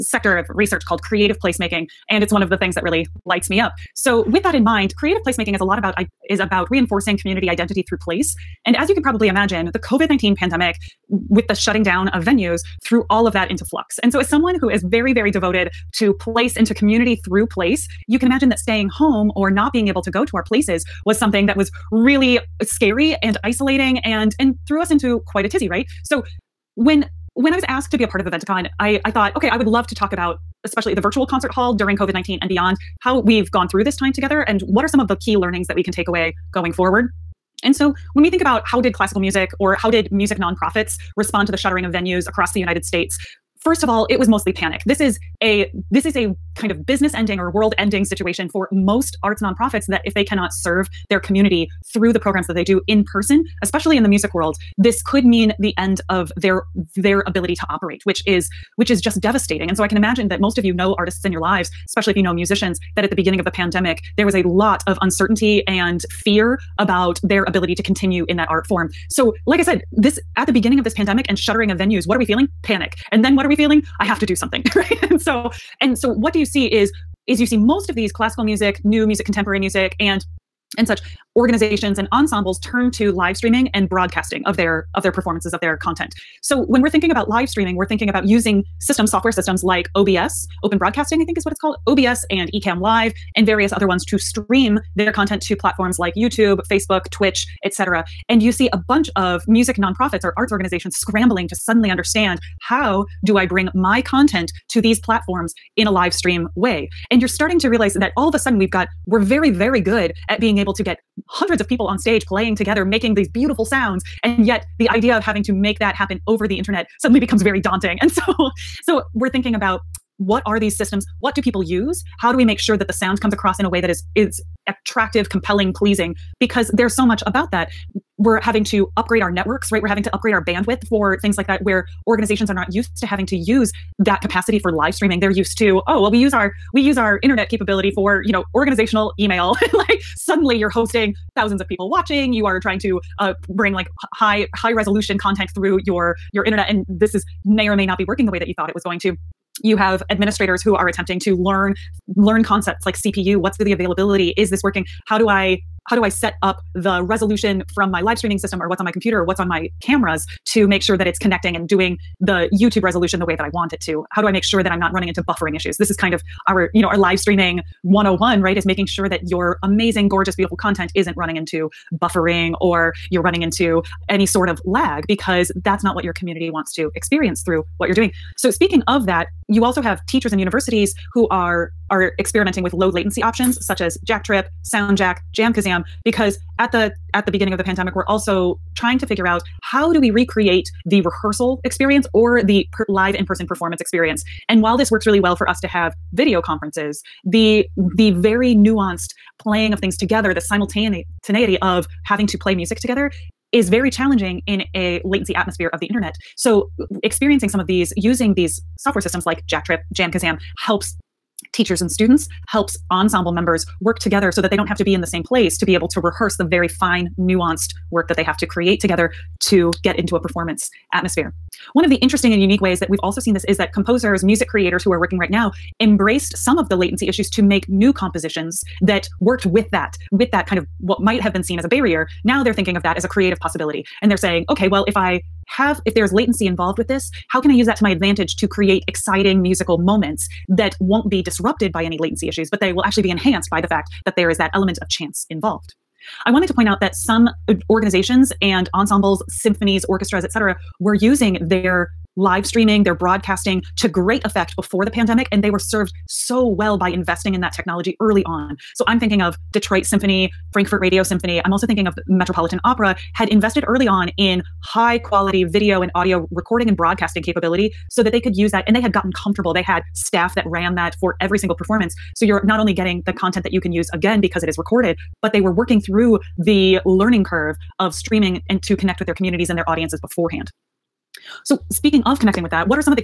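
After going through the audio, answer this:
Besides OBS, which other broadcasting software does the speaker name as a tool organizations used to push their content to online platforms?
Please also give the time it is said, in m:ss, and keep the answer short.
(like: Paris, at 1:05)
Ecamm Live, at 1:32.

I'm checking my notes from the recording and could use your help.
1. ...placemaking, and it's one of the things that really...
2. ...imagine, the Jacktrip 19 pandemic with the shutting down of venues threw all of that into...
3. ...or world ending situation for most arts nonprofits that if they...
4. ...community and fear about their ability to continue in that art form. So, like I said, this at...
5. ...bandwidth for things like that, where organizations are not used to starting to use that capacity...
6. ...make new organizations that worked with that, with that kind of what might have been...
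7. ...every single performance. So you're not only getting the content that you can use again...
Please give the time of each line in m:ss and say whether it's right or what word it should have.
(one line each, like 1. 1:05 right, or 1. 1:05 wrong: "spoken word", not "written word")
1. 0:01 right
2. 0:09 wrong: "COVID", not "Jacktrip"
3. 0:47 right
4. 1:05 wrong: "uncertainty", not "community"
5. 2:10 wrong: "having", not "starting"
6. 3:47 wrong: "compositions", not "organizations"
7. 4:31 right.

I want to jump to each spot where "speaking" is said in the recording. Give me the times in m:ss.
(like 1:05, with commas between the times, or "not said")
2:58, 4:41.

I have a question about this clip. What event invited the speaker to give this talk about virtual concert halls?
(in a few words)
Eventicon.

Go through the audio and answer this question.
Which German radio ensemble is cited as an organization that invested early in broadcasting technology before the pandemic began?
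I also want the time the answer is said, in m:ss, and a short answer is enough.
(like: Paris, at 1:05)
Frankfurt Radio Symphony, at 4:20.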